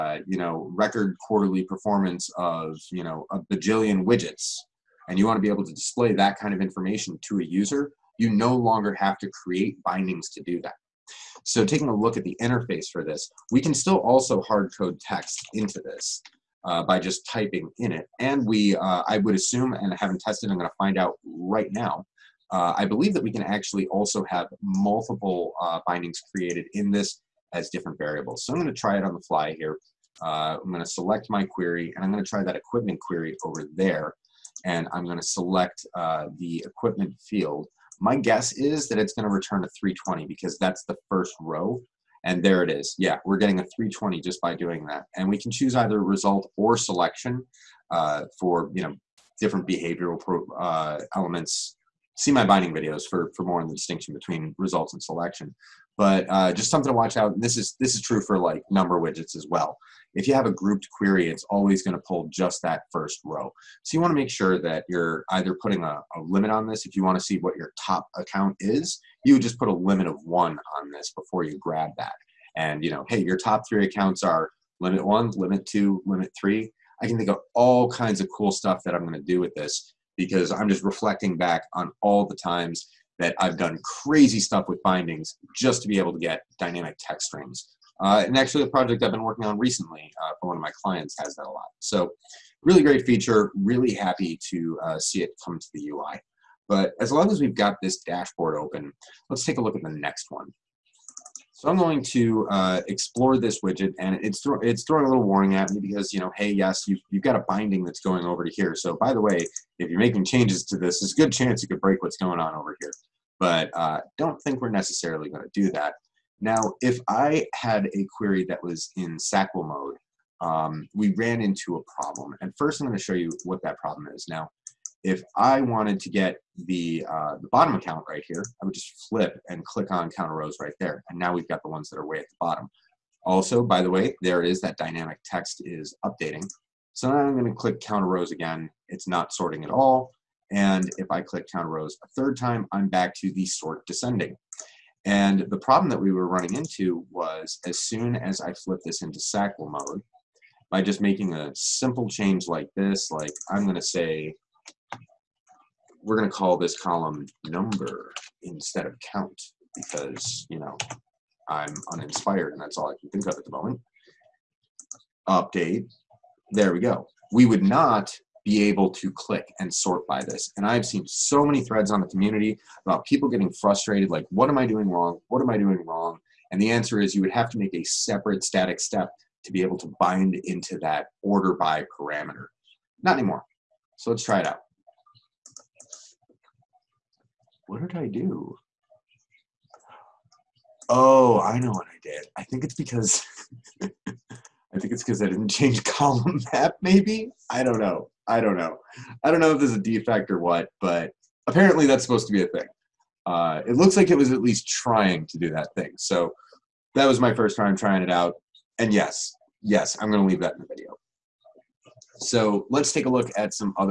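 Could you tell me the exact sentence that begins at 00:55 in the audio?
But uh, just something to watch out.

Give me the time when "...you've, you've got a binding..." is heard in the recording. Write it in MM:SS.
01:46.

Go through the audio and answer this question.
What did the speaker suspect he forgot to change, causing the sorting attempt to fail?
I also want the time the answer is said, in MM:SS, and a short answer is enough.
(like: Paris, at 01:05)
column map, at 03:15.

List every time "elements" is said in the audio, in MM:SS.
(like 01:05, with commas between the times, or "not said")
00:51.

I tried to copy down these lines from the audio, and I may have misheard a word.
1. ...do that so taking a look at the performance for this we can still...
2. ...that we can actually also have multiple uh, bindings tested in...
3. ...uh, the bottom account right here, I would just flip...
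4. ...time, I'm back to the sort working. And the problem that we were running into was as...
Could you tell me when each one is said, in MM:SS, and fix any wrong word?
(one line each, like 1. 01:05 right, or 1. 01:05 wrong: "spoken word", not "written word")
1. 00:10 wrong: "interface", not "performance"
2. 00:23 wrong: "created", not "tested"
3. 02:07 right
4. 02:22 wrong: "descending", not "working".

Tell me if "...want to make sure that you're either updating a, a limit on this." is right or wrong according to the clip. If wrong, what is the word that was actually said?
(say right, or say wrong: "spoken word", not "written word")
wrong: "putting", not "updating".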